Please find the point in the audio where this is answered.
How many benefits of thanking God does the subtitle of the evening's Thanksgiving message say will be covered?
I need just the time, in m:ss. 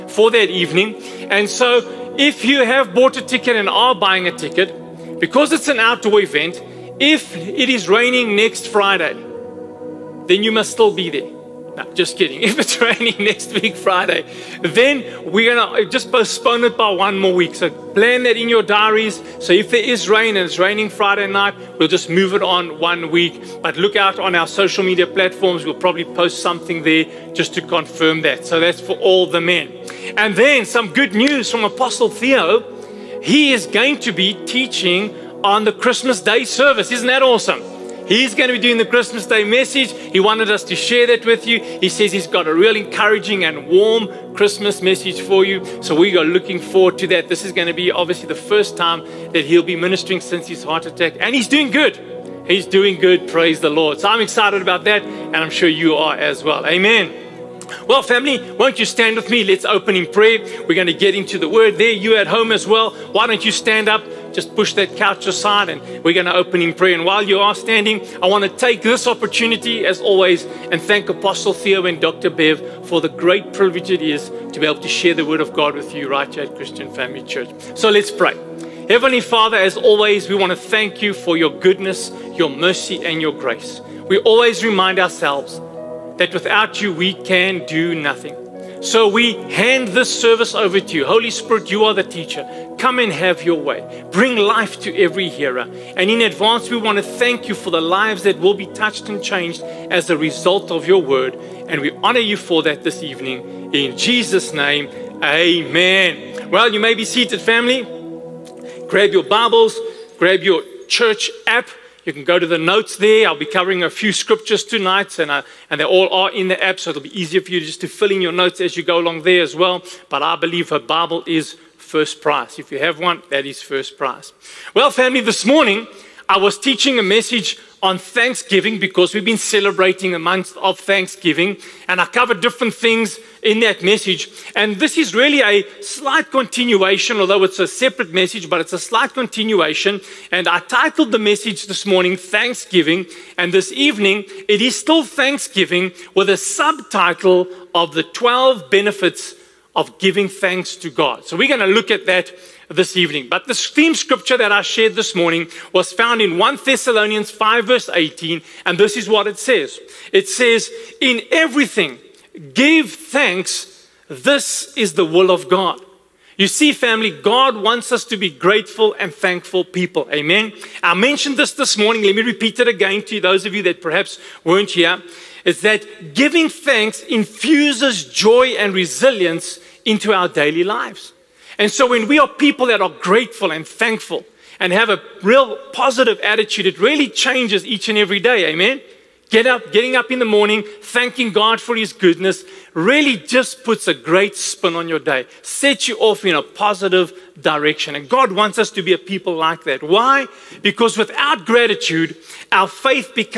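2:28.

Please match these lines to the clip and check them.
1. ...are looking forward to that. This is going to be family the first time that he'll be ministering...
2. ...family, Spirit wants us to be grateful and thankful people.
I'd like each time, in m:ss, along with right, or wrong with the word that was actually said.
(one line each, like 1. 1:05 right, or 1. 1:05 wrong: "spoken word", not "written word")
1. 0:46 wrong: "obviously", not "family"
2. 2:46 wrong: "God", not "Spirit".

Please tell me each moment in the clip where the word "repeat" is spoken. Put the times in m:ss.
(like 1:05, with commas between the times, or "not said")
2:52.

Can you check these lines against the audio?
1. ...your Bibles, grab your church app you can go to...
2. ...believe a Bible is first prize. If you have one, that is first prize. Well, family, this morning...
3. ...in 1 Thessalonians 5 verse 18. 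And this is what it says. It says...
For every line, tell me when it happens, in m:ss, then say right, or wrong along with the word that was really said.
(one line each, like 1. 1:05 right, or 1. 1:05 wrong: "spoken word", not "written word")
1. 1:49 right
2. 2:00 right
3. 2:36 right.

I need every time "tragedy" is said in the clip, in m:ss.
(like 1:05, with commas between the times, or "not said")
not said.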